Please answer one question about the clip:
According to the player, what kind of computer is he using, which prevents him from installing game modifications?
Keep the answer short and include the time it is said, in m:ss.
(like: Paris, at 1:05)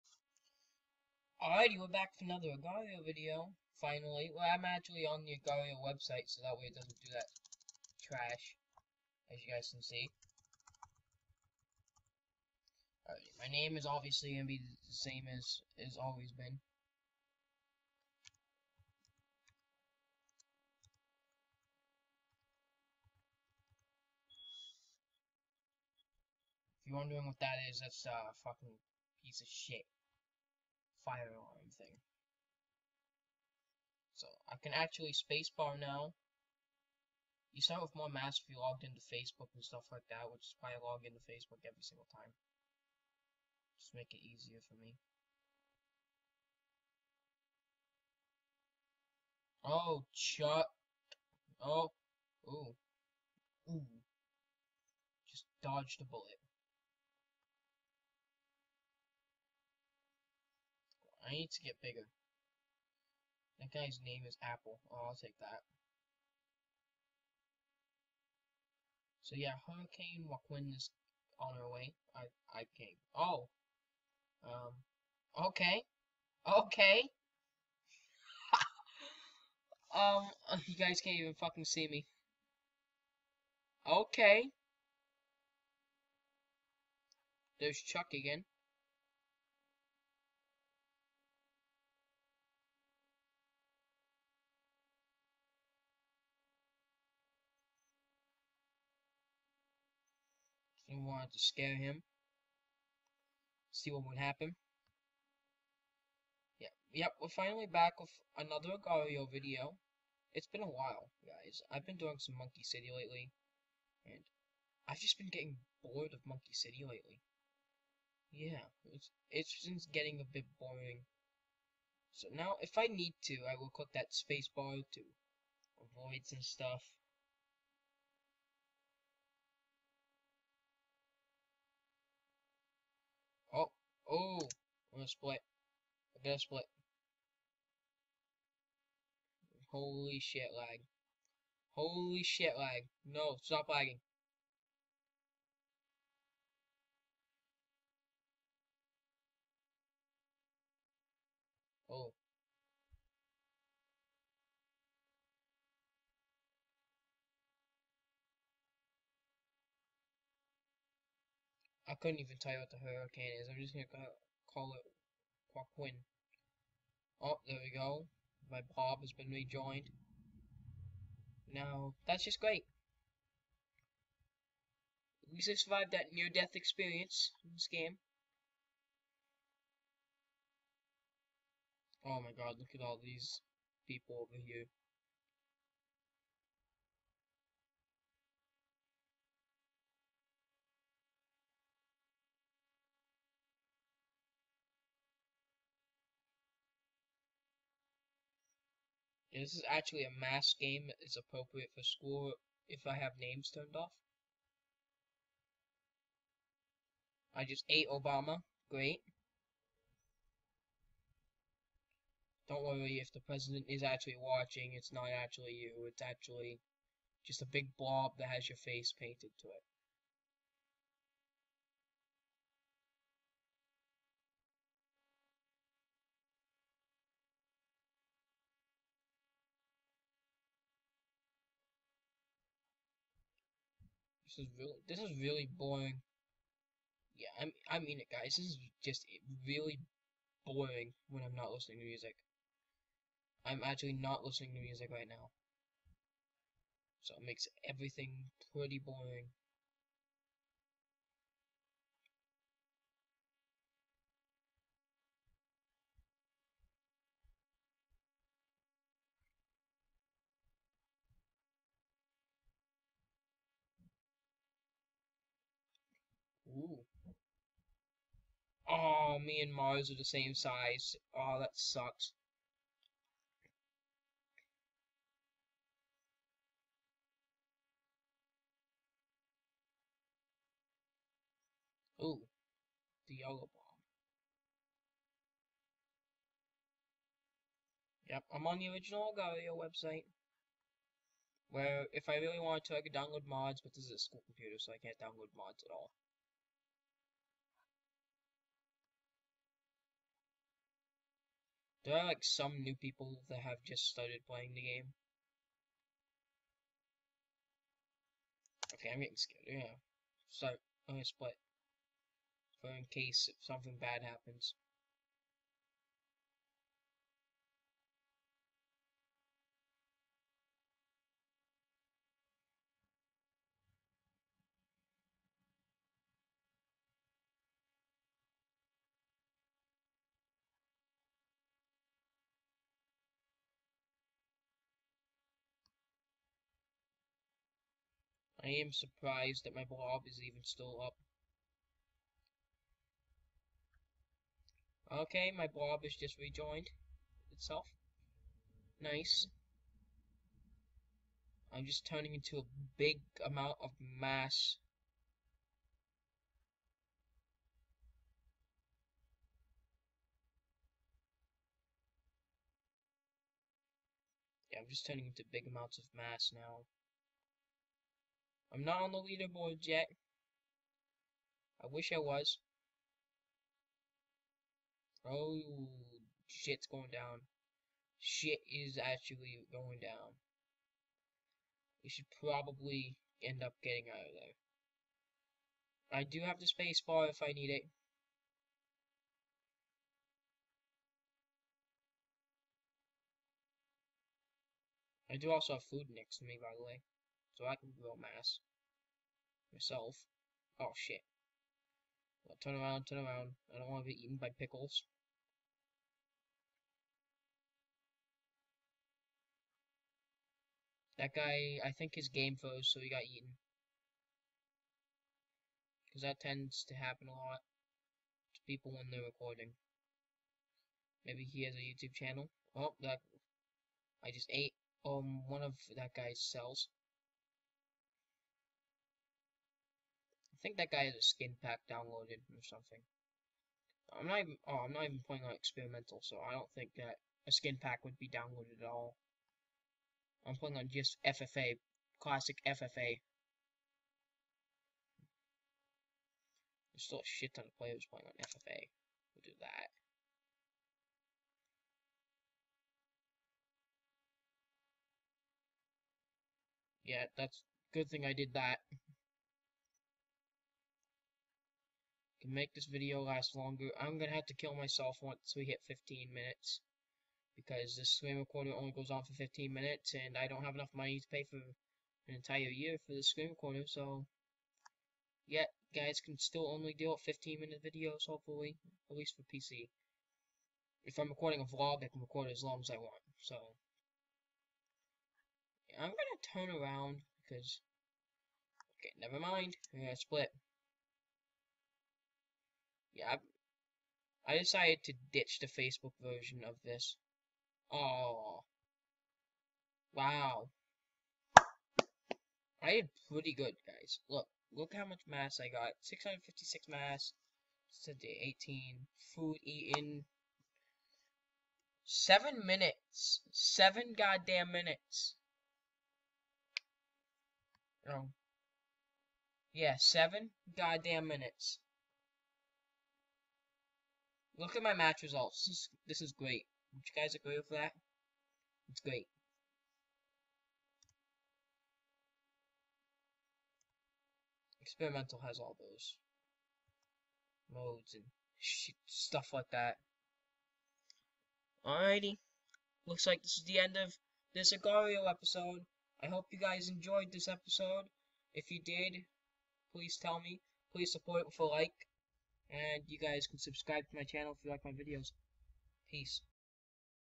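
a school computer, at 4:53.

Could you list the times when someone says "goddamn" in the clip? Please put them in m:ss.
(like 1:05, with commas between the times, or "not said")
8:33, 8:40.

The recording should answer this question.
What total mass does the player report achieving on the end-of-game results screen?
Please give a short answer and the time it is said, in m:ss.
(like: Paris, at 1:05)
656, at 8:25.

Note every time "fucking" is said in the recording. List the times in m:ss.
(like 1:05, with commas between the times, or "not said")
0:28, 1:21.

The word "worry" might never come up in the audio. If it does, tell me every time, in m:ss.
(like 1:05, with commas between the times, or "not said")
3:32.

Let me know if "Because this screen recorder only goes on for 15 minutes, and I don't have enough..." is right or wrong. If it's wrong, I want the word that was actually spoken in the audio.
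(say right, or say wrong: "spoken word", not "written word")
right.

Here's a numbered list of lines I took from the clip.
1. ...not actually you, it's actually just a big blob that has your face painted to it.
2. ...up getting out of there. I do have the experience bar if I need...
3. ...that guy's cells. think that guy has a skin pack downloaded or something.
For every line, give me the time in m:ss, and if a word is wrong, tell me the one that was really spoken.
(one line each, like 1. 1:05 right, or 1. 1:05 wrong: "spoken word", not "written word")
1. 3:34 right
2. 6:23 wrong: "space", not "experience"
3. 7:05 right.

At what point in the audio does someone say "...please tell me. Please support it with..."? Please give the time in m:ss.
9:09.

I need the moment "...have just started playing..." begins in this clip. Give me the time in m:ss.
5:03.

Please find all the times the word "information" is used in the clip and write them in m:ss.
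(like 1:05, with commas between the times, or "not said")
not said.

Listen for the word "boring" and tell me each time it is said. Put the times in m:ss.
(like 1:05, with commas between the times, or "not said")
2:00, 3:55, 4:00, 4:08.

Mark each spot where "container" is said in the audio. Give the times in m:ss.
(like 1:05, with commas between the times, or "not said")
not said.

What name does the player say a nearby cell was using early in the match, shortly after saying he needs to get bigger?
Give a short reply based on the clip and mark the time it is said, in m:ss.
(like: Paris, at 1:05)
Apple, at 1:04.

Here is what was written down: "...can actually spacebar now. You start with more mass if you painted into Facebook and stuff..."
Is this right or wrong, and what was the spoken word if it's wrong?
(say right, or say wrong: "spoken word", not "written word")
wrong: "logged", not "painted".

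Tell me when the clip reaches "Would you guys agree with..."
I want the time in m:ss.
8:46.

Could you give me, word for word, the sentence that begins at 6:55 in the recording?
Because that tends to happen a lot to people when they're recording.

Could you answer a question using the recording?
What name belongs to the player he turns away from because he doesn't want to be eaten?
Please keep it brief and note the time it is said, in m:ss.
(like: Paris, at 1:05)
pickles, at 6:44.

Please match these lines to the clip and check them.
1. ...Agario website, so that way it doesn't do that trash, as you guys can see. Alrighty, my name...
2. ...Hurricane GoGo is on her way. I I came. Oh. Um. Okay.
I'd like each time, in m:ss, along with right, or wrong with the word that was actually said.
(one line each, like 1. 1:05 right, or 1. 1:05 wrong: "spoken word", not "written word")
1. 0:05 right
2. 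1:09 wrong: "Joaquin", not "GoGo".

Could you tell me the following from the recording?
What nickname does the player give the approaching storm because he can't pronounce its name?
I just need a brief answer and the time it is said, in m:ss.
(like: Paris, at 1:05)
Quaquin, at 2:45.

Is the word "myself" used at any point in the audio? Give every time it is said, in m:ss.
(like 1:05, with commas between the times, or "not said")
6:39, 7:44.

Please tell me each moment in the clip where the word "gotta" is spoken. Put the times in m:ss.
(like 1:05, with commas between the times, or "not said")
2:16.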